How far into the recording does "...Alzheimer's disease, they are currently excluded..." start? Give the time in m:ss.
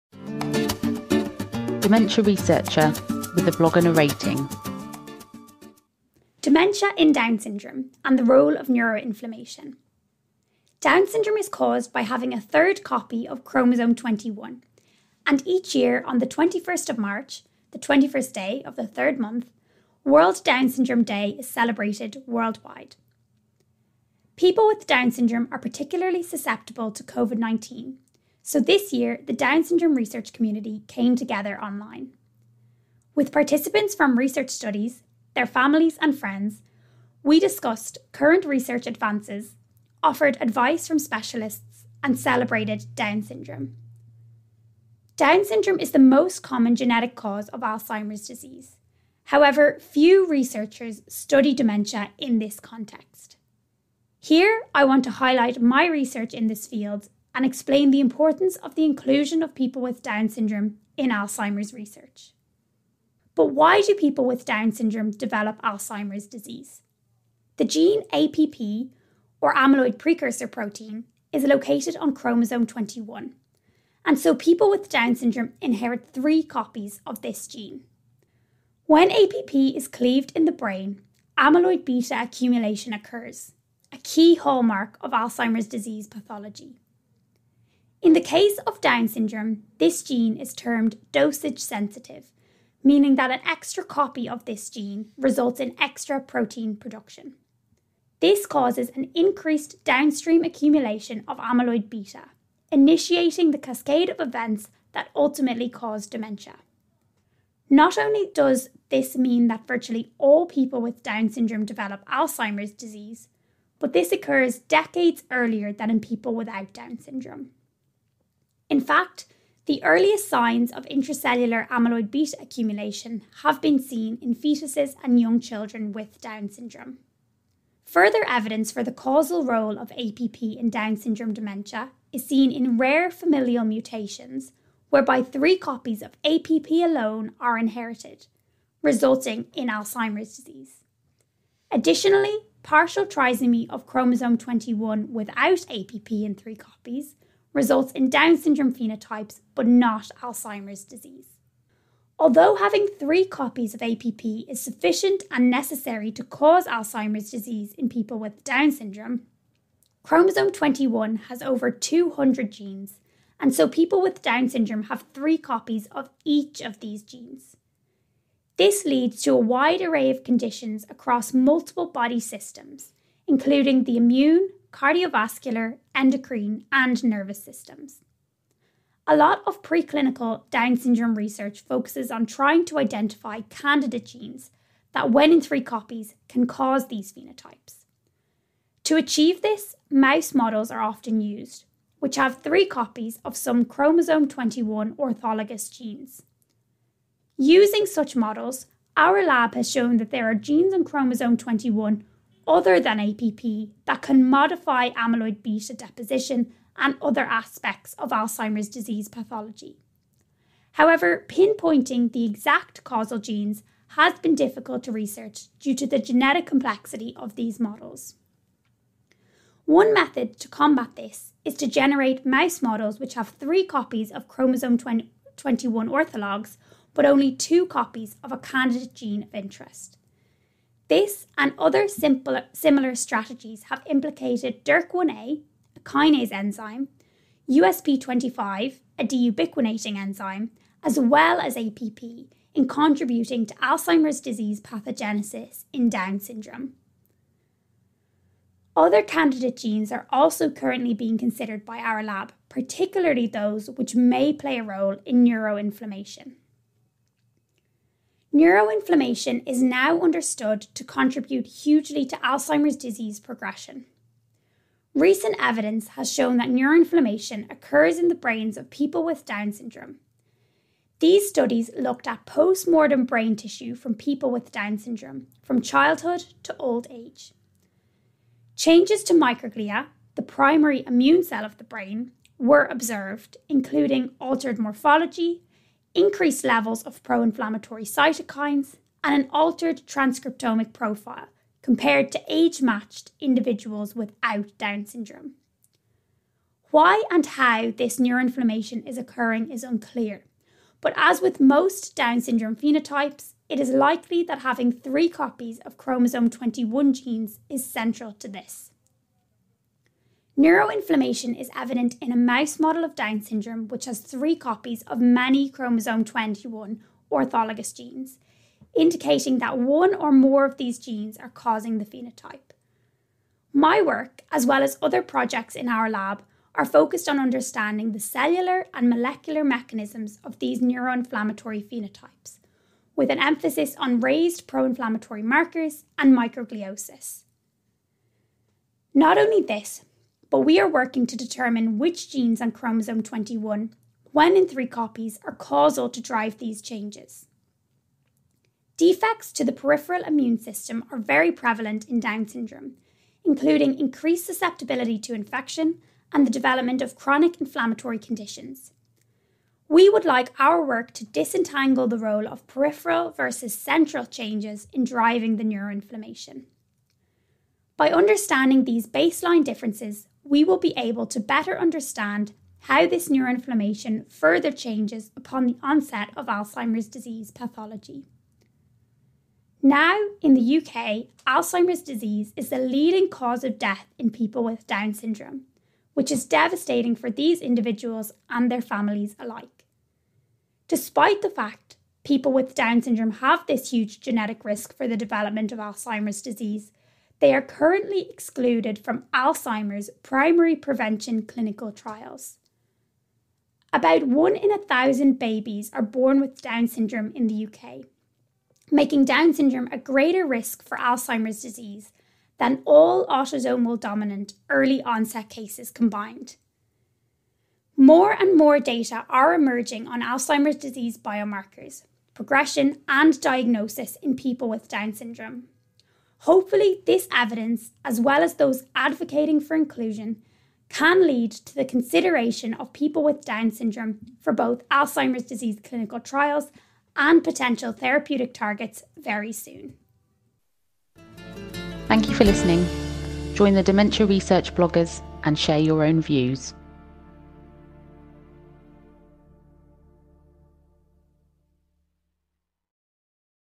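6:35.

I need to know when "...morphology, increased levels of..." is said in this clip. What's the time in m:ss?
4:44.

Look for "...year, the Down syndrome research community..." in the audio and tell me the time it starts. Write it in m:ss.
0:28.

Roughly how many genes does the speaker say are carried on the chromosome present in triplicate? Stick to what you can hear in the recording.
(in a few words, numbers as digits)
Over 200.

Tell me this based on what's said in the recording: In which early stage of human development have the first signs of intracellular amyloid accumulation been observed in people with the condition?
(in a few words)
Fetuses.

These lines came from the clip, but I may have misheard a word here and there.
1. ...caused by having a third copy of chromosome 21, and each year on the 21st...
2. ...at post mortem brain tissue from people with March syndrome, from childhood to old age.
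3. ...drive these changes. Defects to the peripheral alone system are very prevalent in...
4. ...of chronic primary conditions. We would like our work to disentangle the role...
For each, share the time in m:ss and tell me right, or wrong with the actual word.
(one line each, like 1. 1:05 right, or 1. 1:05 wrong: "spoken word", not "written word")
1. 0:11 right
2. 4:32 wrong: "Down", not "March"
3. 5:46 wrong: "immune", not "alone"
4. 5:56 wrong: "inflammatory", not "primary".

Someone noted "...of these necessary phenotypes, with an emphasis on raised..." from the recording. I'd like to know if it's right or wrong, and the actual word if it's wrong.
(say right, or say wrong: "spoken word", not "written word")
wrong: "neuroinflammatory", not "necessary".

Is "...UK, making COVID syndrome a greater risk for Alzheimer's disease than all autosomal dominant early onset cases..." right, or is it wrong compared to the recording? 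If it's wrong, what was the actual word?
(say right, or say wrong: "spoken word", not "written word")
wrong: "Down", not "COVID".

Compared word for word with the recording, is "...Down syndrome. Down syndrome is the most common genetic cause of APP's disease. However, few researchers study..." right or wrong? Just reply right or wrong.
wrong.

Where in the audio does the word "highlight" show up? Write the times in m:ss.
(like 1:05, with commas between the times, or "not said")
0:55.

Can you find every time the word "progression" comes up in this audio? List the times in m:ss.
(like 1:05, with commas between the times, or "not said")
4:23, 7:02.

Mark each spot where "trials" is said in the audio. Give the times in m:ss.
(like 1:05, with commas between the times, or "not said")
6:41, 7:15.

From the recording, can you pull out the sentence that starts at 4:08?
Other candidate genes are also currently being considered by our lab, particularly those which may play a role in neuroinflammation.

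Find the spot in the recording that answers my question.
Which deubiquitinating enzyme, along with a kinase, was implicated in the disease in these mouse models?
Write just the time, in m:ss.
3:57.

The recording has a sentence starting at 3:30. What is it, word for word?
However, pinpointing the exact causal genes has been difficult to research due to the genetic complexity of these models.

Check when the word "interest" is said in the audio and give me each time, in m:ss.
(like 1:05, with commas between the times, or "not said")
3:49.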